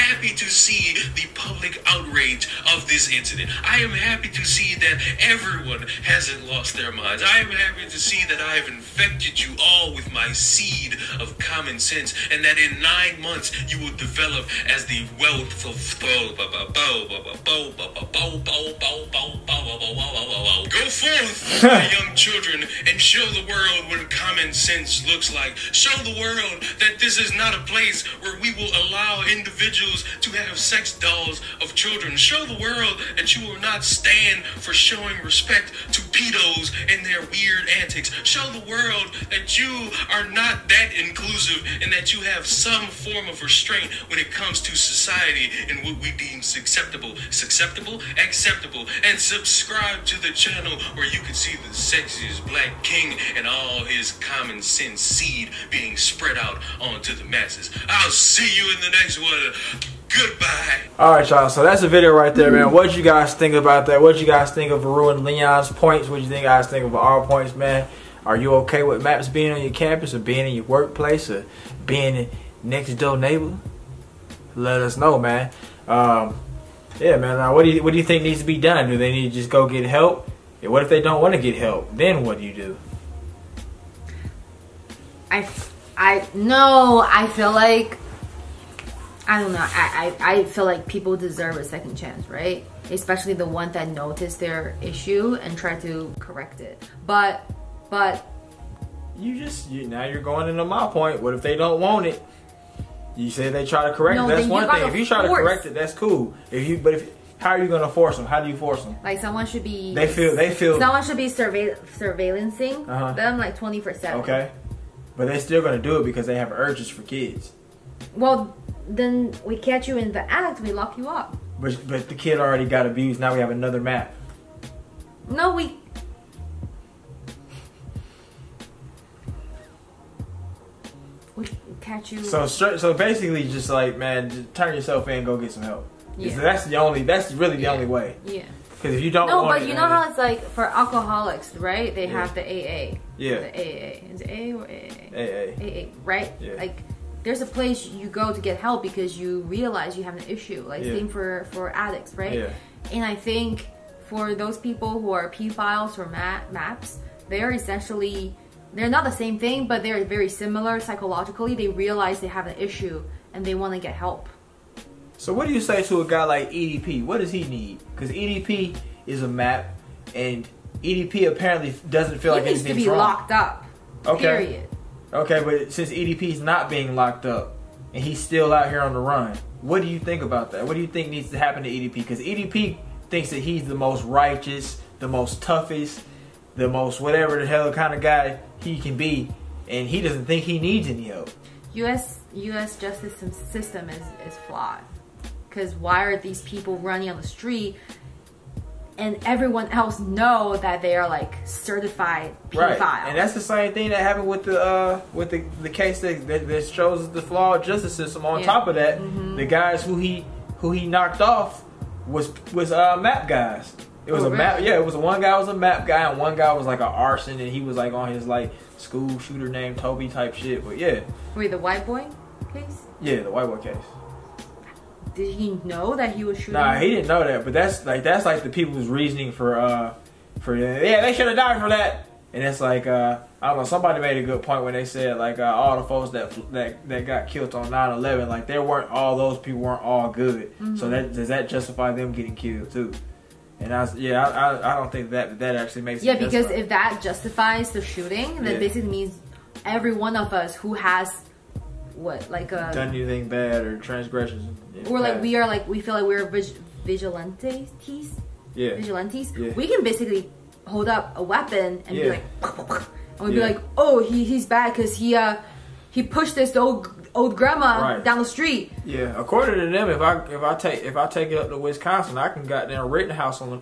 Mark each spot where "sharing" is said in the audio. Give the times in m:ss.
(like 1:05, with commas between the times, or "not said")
not said.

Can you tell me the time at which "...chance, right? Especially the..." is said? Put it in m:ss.
1:31.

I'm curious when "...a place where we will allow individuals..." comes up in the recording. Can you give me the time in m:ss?
0:27.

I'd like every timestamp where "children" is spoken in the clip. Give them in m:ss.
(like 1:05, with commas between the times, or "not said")
0:22, 0:31.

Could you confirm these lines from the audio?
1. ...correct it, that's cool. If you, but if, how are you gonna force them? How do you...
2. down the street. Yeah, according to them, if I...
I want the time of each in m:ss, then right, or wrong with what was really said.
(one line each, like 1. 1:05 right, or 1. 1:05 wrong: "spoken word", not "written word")
1. 1:45 right
2. 4:28 right.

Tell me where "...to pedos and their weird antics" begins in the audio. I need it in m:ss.
0:35.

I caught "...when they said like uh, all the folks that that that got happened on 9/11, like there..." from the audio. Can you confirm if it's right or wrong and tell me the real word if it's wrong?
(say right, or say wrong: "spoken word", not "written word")
wrong: "killed", not "happened".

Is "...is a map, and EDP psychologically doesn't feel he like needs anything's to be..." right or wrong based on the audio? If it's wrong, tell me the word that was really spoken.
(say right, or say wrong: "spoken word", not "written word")
wrong: "apparently", not "psychologically".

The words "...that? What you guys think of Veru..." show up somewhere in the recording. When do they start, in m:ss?
1:03.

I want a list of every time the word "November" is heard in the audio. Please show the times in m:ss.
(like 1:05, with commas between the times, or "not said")
not said.